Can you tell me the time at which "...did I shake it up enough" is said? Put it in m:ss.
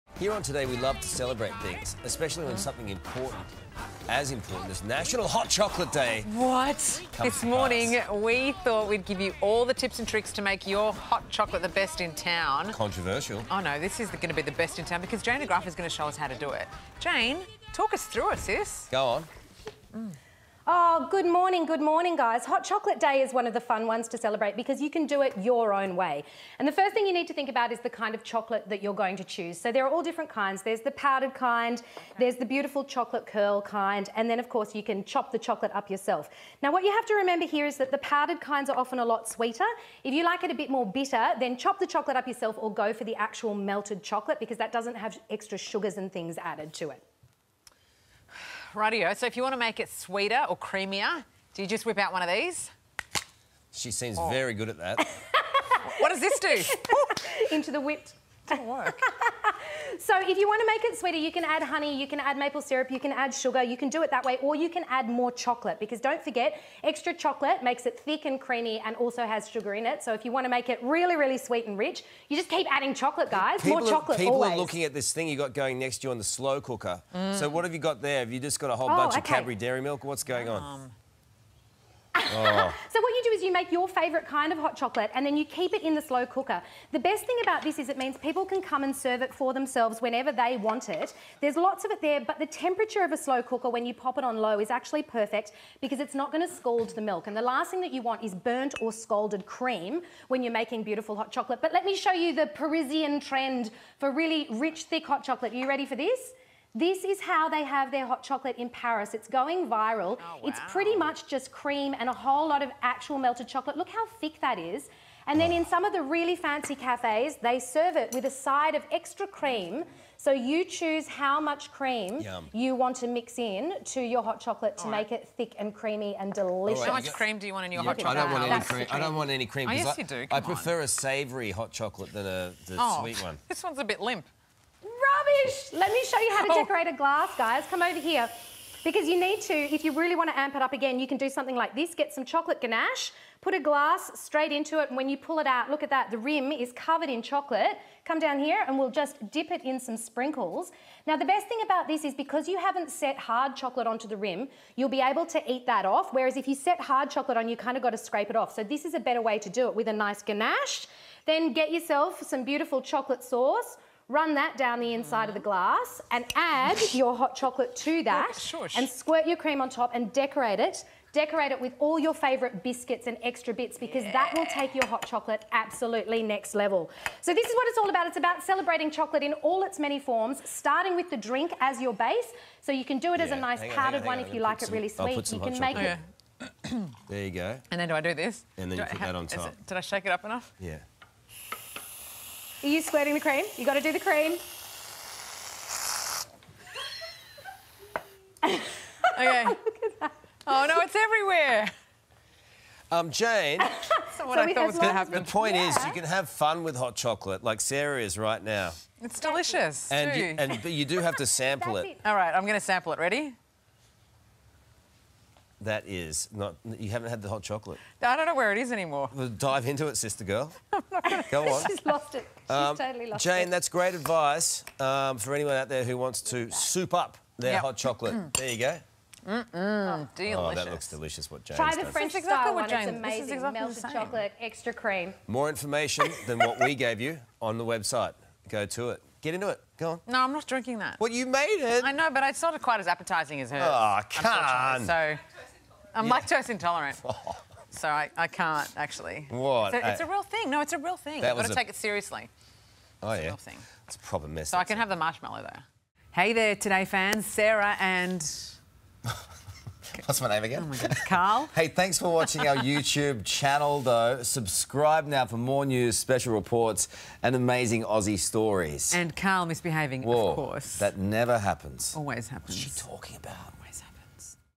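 3:09.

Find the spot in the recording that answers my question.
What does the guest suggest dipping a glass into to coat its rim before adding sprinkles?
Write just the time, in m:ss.
2:22.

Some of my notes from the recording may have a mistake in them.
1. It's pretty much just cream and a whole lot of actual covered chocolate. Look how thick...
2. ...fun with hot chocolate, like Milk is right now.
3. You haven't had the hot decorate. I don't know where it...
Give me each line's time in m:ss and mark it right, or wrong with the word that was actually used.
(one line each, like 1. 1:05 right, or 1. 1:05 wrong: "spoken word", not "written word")
1. 1:50 wrong: "melted", not "covered"
2. 3:26 wrong: "Sarah", not "Milk"
3. 3:36 wrong: "chocolate", not "decorate".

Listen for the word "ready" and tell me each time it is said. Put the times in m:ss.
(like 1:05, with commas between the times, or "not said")
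1:45, 3:32.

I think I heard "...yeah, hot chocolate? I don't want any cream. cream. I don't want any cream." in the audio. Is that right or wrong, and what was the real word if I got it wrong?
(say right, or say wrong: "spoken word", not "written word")
right.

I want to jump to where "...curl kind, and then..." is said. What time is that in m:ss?
0:33.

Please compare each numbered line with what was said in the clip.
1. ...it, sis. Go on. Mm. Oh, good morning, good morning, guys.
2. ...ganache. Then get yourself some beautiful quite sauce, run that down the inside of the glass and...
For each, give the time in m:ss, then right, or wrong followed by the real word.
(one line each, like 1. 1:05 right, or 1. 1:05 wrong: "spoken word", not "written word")
1. 0:18 right
2. 2:40 wrong: "chocolate", not "quite".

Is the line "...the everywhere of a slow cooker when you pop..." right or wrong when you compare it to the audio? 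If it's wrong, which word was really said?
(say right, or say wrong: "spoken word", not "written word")
wrong: "temperature", not "everywhere".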